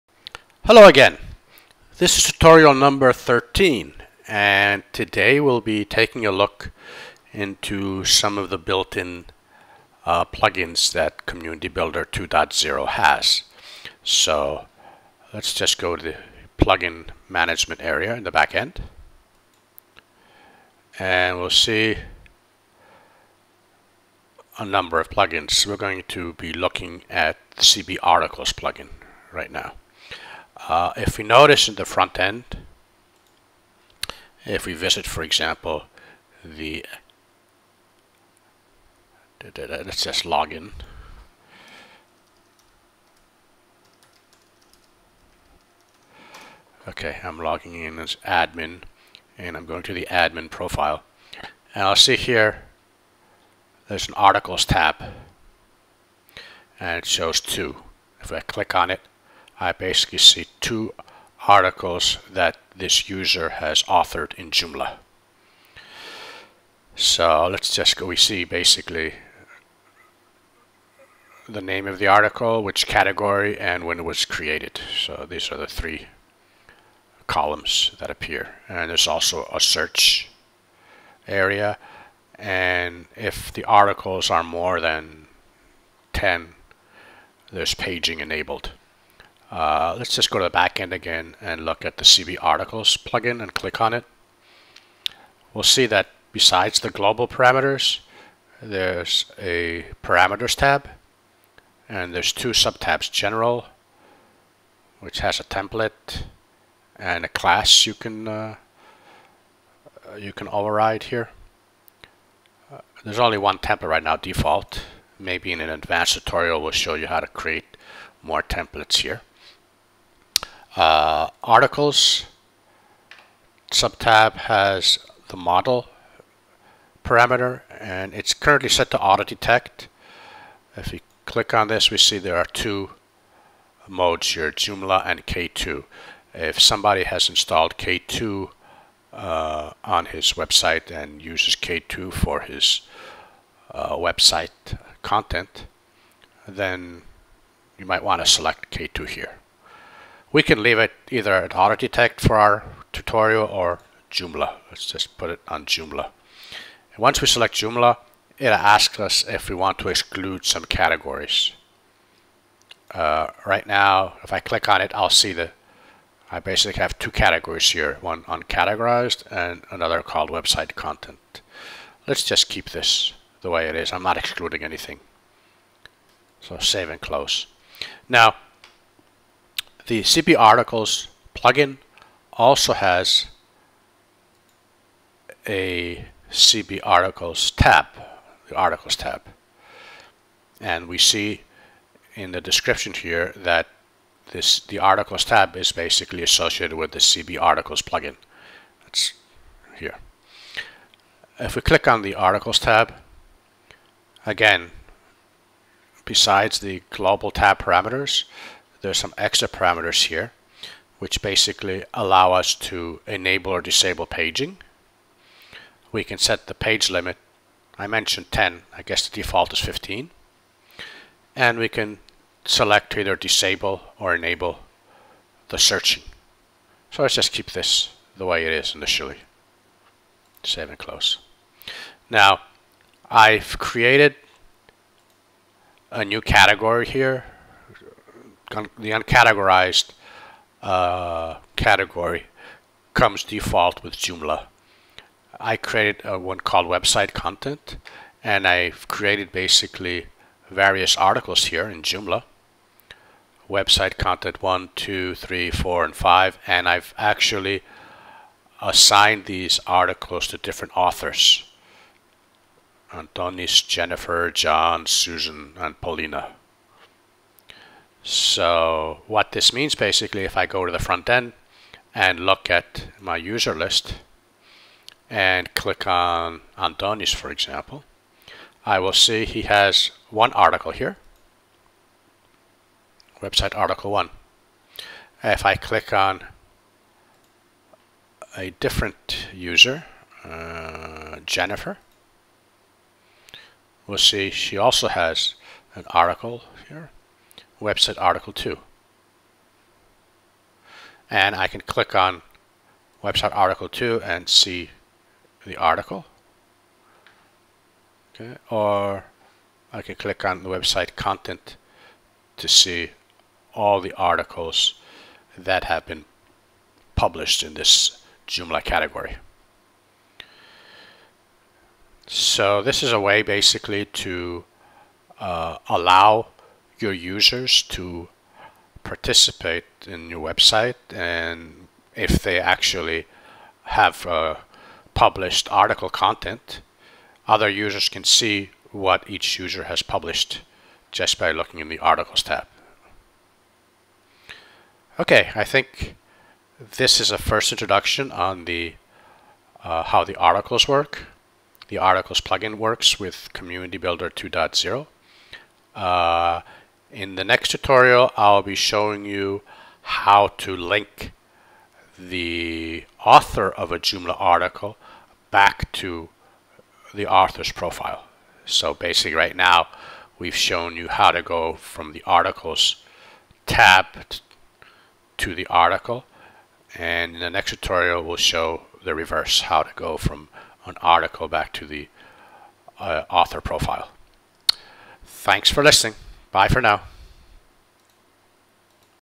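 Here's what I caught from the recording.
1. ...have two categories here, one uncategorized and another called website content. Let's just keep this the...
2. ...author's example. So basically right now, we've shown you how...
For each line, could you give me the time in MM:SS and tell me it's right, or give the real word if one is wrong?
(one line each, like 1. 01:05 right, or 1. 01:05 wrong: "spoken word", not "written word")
1. 02:46 right
2. 06:07 wrong: "profile", not "example".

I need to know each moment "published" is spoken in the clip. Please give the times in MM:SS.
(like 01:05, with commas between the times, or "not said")
05:16, 05:34, 05:39.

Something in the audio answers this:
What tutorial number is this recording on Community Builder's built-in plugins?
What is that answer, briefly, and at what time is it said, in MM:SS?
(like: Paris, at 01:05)
13, at 00:03.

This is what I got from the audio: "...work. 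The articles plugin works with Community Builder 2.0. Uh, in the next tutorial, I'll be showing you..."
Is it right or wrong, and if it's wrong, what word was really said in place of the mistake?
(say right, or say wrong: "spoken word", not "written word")
right.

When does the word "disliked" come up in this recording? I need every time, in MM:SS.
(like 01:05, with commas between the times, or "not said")
not said.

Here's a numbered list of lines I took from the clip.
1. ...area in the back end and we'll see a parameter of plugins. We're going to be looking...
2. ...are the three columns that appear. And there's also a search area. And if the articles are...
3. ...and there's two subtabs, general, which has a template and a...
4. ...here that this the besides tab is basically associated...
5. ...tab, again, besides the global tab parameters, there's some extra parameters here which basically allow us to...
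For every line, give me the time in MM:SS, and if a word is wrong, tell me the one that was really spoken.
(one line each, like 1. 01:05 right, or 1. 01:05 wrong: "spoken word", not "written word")
1. 00:17 wrong: "number", not "parameter"
2. 01:15 right
3. 01:41 right
4. 03:12 wrong: "articles", not "besides"
5. 03:22 right.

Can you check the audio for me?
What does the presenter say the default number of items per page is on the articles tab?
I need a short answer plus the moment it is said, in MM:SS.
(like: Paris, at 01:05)
15, at 03:39.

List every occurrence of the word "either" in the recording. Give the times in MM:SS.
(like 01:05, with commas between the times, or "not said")
02:31, 03:42.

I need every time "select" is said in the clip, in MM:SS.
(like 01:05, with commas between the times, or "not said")
02:28, 02:37, 03:42.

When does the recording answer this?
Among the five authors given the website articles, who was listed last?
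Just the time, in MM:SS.
04:25.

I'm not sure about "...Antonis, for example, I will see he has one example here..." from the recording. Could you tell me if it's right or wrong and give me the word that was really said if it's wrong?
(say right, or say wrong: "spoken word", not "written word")
wrong: "article", not "example".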